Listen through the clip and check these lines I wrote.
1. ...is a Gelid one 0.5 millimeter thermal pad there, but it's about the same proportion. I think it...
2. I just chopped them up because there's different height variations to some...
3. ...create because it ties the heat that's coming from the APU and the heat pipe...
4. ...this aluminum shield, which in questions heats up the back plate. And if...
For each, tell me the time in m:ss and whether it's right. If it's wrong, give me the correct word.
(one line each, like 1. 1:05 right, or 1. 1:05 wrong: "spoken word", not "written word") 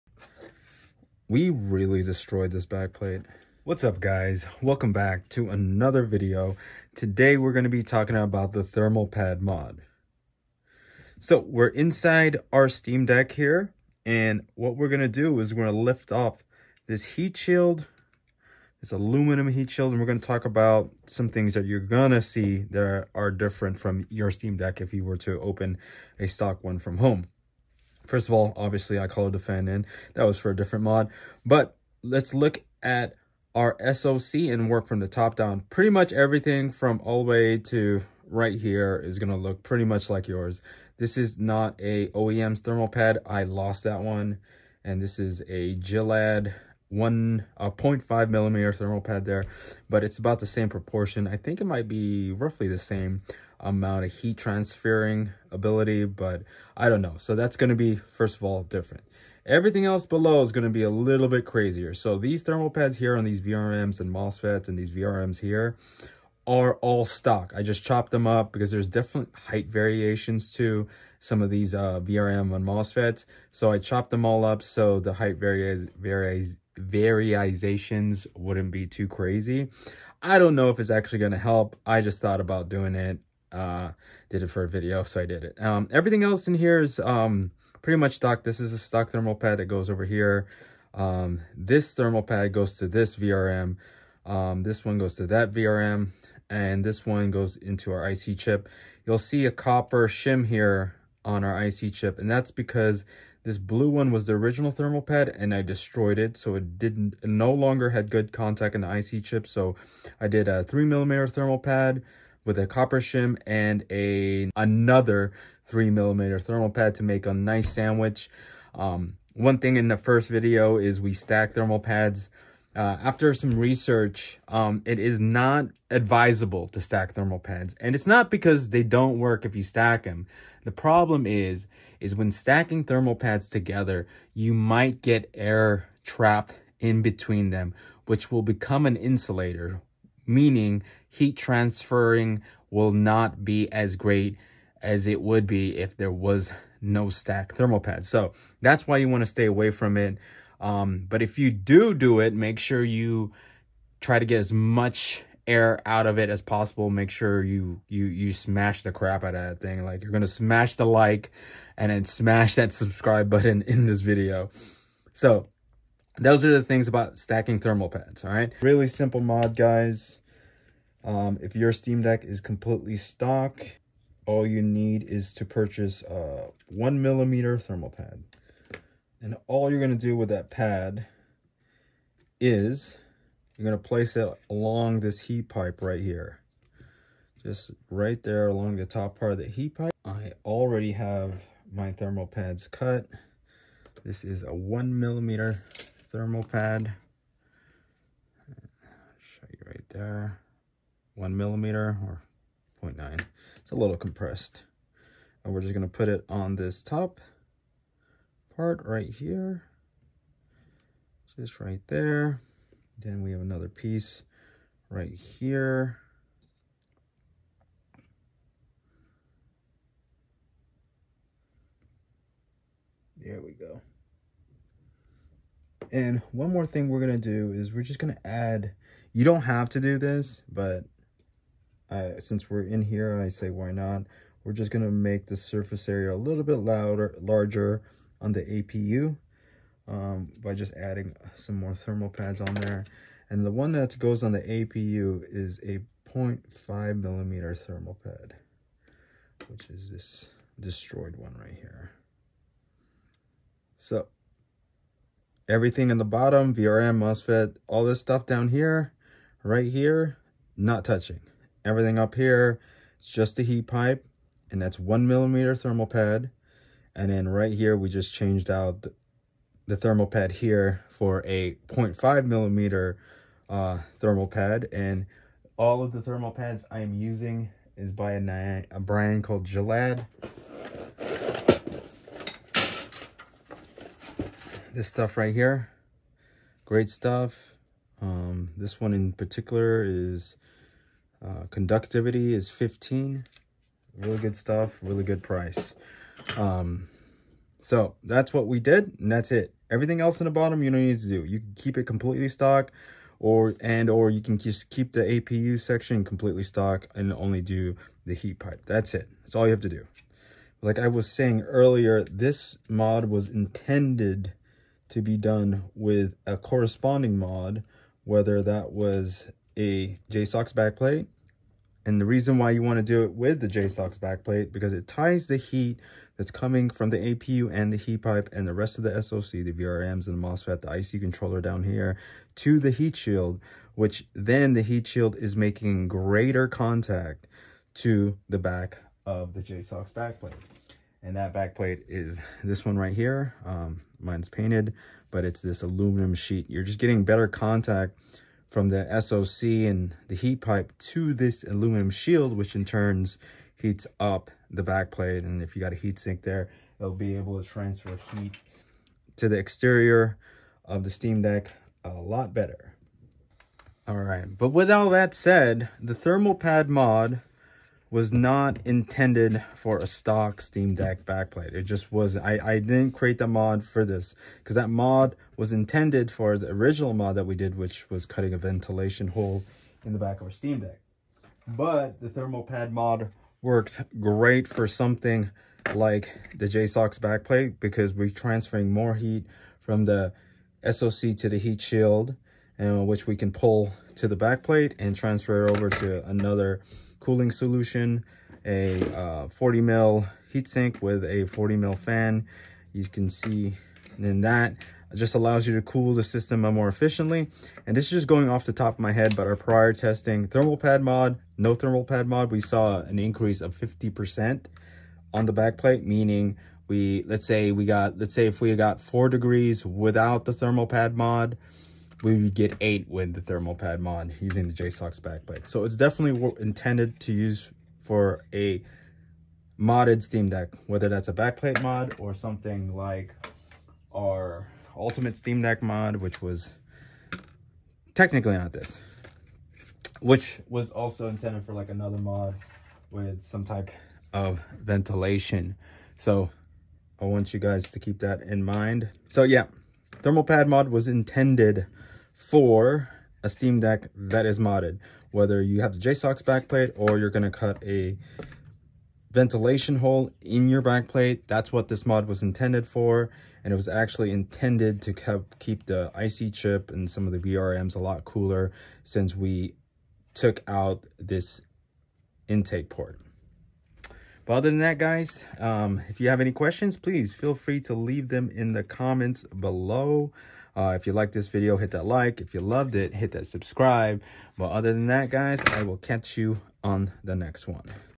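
1. 0:45 right
2. 1:07 right
3. 5:23 wrong: "backplate", not "create"
4. 5:51 wrong: "turns", not "questions".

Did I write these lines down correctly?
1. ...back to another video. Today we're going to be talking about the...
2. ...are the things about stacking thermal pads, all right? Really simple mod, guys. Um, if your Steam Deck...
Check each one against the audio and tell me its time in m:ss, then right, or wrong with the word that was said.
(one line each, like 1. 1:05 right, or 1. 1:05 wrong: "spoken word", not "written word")
1. 0:04 right
2. 2:46 right.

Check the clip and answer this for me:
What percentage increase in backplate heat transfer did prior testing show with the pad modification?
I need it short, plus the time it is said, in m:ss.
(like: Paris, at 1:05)
50%, at 6:53.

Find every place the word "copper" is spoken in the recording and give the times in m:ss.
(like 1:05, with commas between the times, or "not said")
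1:39, 1:52.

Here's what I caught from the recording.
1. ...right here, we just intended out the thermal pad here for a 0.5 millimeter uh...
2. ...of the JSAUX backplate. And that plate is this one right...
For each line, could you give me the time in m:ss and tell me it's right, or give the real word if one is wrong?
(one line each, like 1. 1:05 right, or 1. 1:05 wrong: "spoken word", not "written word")
1. 4:27 wrong: "changed", not "intended"
2. 5:39 wrong: "backplate", not "plate".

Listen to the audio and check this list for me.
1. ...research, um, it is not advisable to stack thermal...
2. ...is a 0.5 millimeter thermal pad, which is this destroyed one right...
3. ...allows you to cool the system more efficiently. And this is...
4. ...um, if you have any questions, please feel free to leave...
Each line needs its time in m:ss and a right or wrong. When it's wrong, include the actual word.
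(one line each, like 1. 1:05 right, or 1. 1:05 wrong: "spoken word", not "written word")
1. 2:03 right
2. 4:05 right
3. 6:45 right
4. 7:55 right.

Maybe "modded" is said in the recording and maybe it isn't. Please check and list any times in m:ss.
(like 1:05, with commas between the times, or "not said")
7:09, 7:34.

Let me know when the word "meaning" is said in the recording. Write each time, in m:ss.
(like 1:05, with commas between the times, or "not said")
2:20, 6:55.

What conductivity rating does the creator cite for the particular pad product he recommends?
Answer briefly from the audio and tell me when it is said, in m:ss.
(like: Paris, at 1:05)
15, at 4:52.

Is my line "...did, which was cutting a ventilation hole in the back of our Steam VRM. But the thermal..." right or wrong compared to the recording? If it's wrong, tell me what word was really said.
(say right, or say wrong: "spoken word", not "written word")
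wrong: "Deck", not "VRM".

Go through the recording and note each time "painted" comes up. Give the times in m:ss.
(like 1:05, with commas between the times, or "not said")
5:44.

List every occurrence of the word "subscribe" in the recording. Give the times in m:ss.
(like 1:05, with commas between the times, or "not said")
2:42, 8:03.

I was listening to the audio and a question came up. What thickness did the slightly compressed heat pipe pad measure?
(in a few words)
0.9.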